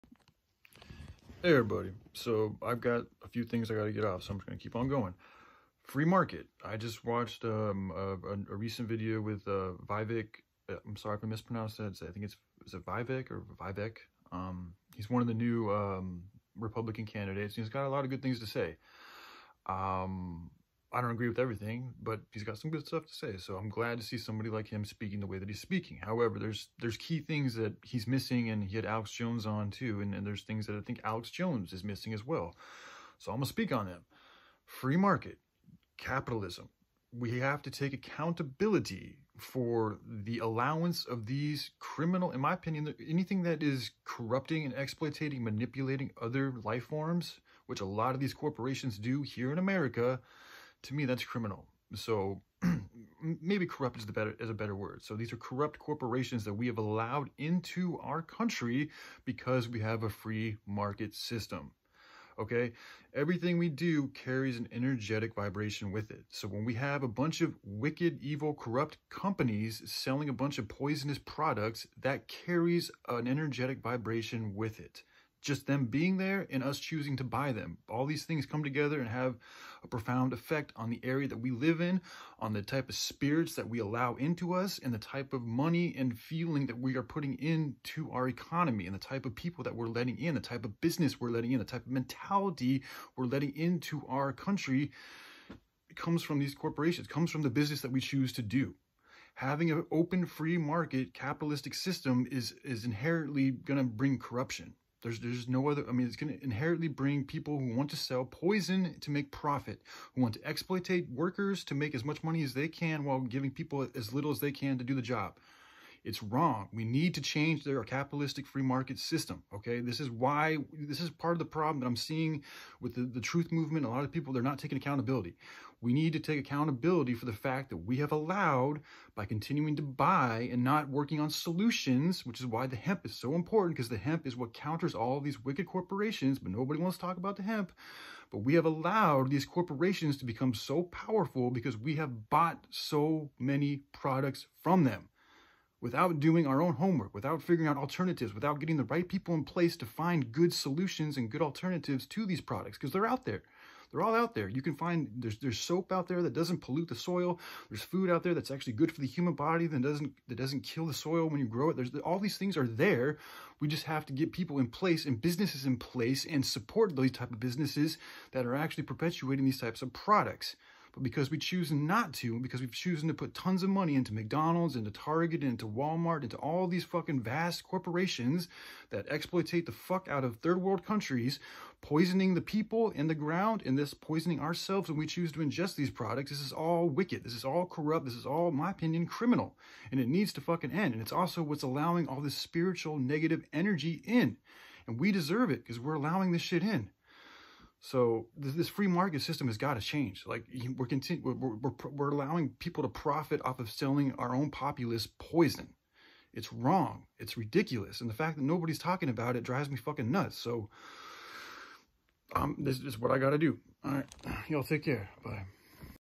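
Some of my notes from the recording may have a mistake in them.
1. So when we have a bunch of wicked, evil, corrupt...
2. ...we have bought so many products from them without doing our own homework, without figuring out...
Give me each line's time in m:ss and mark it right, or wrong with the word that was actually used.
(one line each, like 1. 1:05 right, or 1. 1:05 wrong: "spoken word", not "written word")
1. 1:06 right
2. 2:21 right.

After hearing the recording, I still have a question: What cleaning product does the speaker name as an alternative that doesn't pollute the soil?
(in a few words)
Soap.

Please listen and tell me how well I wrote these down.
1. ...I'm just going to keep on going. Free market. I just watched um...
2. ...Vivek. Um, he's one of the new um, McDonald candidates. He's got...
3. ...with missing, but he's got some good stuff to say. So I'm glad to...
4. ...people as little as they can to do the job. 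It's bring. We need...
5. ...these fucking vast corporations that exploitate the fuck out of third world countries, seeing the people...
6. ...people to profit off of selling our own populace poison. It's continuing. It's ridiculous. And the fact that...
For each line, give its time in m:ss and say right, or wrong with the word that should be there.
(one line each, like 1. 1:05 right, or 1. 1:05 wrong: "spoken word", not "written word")
1. 0:04 right
2. 0:13 wrong: "Republican", not "McDonald"
3. 0:21 wrong: "everything", not "missing"
4. 1:53 wrong: "wrong", not "bring"
5. 2:56 wrong: "poisoning", not "seeing"
6. 3:22 wrong: "wrong", not "continuing".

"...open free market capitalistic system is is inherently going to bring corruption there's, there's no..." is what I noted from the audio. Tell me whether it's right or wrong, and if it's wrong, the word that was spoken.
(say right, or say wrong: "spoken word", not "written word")
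right.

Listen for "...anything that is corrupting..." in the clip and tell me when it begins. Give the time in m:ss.
0:43.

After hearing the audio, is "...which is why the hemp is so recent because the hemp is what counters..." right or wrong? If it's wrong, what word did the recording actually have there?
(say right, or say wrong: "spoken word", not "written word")
wrong: "important", not "recent".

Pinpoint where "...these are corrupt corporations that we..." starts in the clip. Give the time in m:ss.
0:55.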